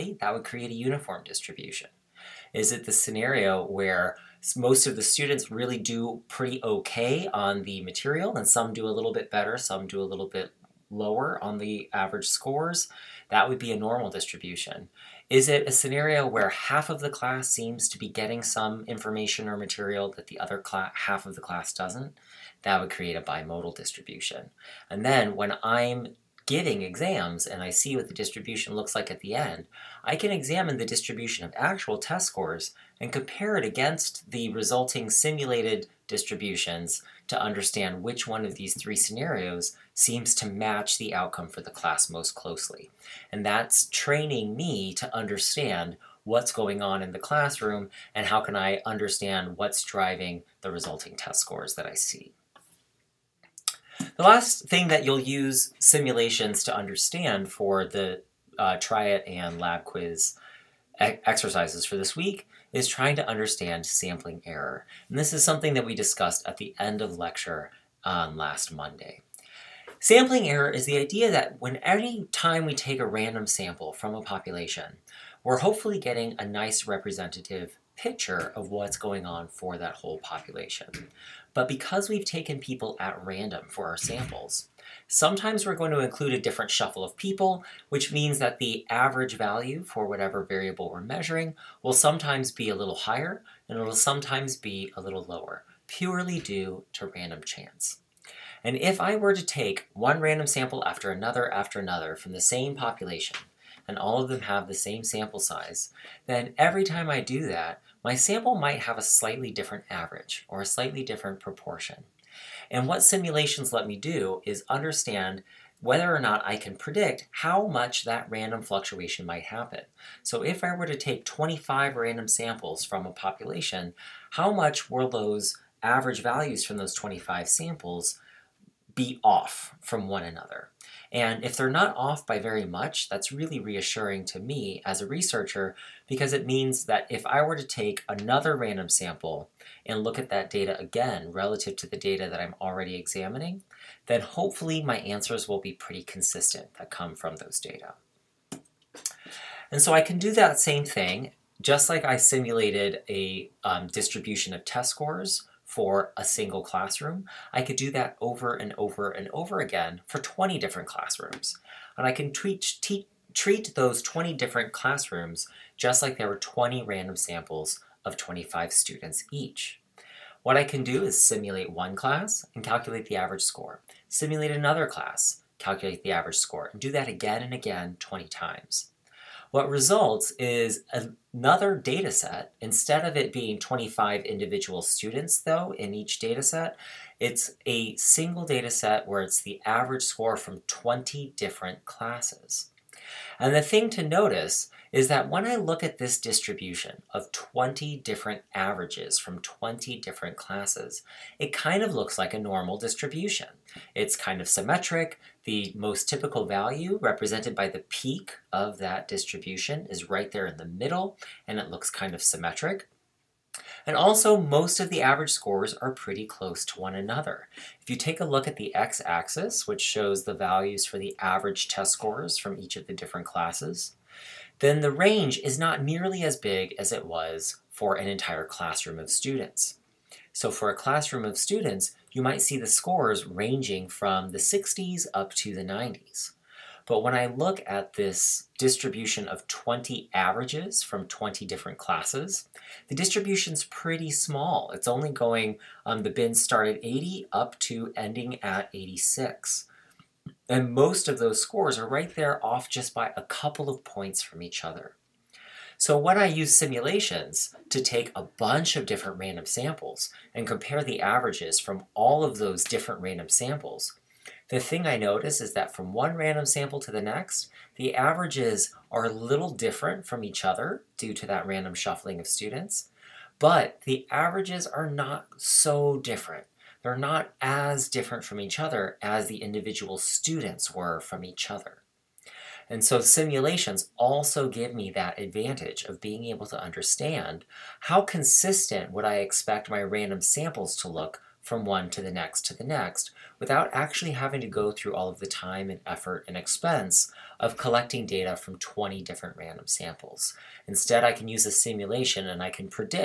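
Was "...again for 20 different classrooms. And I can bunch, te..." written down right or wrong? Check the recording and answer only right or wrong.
wrong.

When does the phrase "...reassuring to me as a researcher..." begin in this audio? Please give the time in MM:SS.
02:13.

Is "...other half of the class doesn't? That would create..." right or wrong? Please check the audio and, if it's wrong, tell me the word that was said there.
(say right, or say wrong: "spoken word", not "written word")
right.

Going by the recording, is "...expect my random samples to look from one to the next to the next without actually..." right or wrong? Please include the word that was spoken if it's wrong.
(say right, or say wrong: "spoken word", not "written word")
right.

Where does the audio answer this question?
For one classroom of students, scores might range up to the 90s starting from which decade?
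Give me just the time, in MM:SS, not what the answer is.
03:54.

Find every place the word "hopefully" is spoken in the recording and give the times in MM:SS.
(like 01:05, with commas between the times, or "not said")
01:15, 02:24.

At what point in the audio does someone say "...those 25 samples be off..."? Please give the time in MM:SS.
02:06.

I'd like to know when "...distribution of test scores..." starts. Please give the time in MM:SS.
02:33.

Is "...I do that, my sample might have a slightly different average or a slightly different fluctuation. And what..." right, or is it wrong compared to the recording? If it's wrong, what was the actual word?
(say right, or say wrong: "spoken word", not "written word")
wrong: "proportion", not "fluctuation".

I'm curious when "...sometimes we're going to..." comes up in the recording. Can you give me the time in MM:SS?
01:25.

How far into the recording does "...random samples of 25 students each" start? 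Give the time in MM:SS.
02:46.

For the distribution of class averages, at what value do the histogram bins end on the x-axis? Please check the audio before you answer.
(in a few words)
86.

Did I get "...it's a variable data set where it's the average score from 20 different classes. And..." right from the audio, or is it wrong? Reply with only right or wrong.
wrong.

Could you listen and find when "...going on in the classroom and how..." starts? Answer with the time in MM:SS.
00:46.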